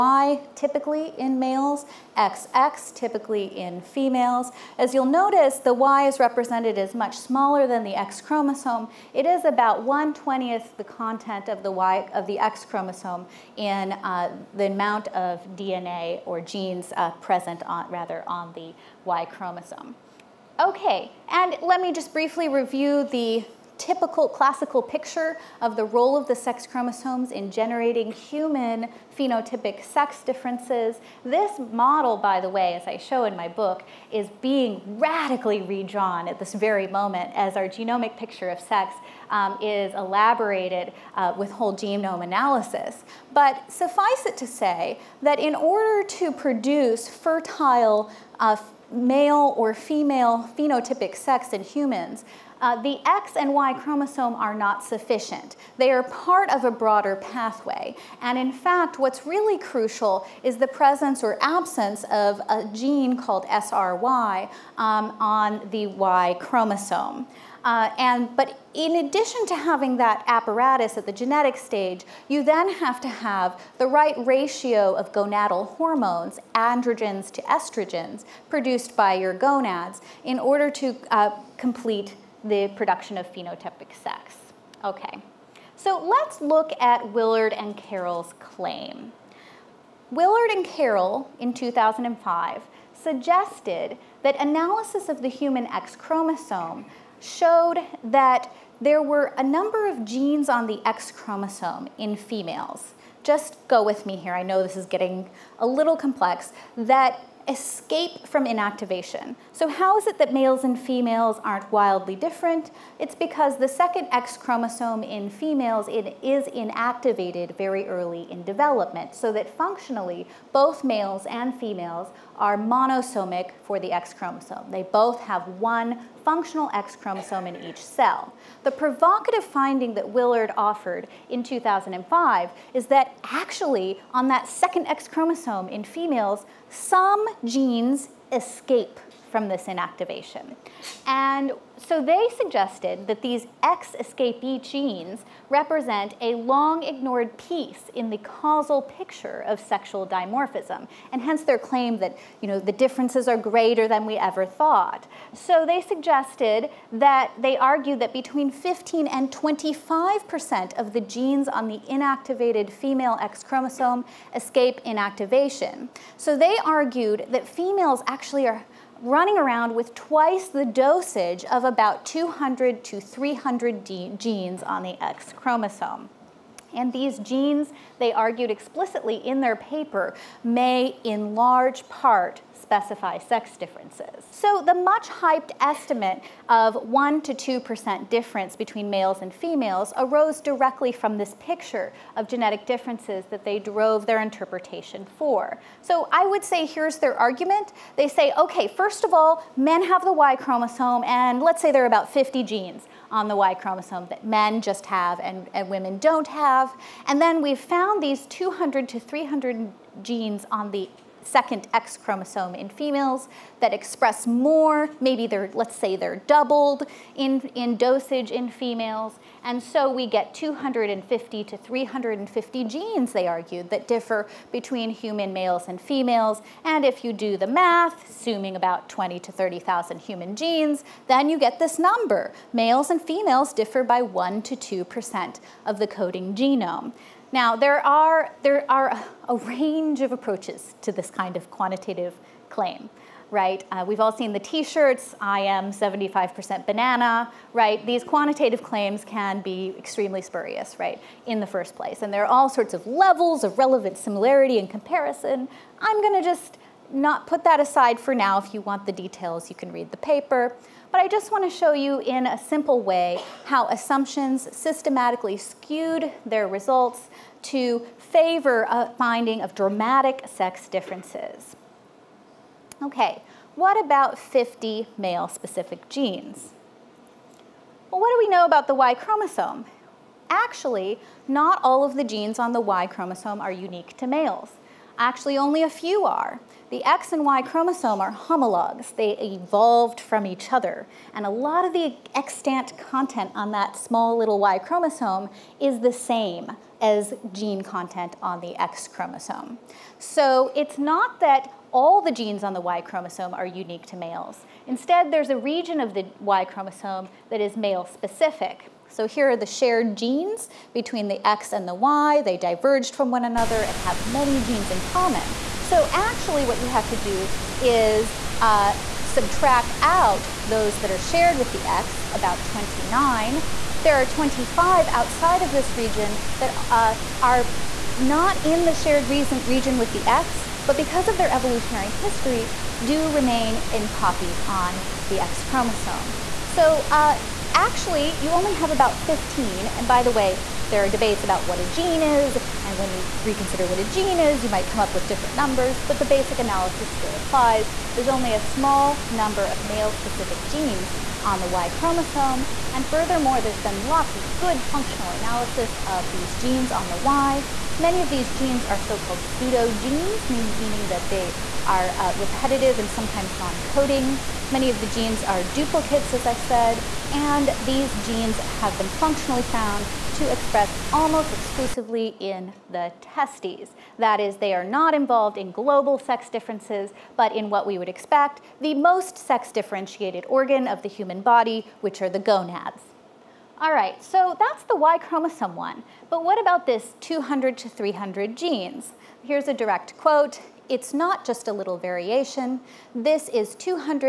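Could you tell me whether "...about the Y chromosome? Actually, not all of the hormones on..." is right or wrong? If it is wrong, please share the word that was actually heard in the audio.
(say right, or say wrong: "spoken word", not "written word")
wrong: "genes", not "hormones".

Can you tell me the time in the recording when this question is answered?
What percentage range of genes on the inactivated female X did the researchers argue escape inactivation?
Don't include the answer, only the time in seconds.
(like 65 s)
158 s.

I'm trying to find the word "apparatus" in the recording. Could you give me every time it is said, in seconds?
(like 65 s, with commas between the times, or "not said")
70 s.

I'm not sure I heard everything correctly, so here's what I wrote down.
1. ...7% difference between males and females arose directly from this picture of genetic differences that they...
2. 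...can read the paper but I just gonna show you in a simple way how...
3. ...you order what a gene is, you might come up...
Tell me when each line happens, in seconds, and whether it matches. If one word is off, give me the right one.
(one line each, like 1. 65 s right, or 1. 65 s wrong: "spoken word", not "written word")
1. 187 s wrong: "2", not "7"
2. 259 s wrong: "wanna", not "gonna"
3. 342 s wrong: "reconsider", not "order".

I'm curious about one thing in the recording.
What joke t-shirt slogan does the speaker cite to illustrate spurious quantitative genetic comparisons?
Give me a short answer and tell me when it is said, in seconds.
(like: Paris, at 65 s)
I am 75% banana, at 245 s.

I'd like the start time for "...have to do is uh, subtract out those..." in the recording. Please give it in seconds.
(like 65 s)
316 s.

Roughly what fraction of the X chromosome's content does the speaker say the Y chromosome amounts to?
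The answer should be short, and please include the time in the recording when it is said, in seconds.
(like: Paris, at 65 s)
1/20, at 9 s.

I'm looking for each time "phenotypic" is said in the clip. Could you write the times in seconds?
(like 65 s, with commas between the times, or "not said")
29 s, 50 s, 83 s.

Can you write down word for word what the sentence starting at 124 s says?
They both have one functional X chromosome in each cell.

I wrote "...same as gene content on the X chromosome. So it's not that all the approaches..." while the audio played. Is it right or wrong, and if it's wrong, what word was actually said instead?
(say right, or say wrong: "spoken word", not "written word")
wrong: "genes", not "approaches".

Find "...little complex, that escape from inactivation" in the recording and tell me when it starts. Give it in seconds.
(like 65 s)
105 s.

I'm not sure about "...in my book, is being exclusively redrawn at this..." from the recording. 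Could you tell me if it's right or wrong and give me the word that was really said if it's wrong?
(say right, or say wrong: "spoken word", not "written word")
wrong: "radically", not "exclusively".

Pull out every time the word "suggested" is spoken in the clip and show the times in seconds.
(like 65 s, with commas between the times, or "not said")
92 s, 142 s, 155 s.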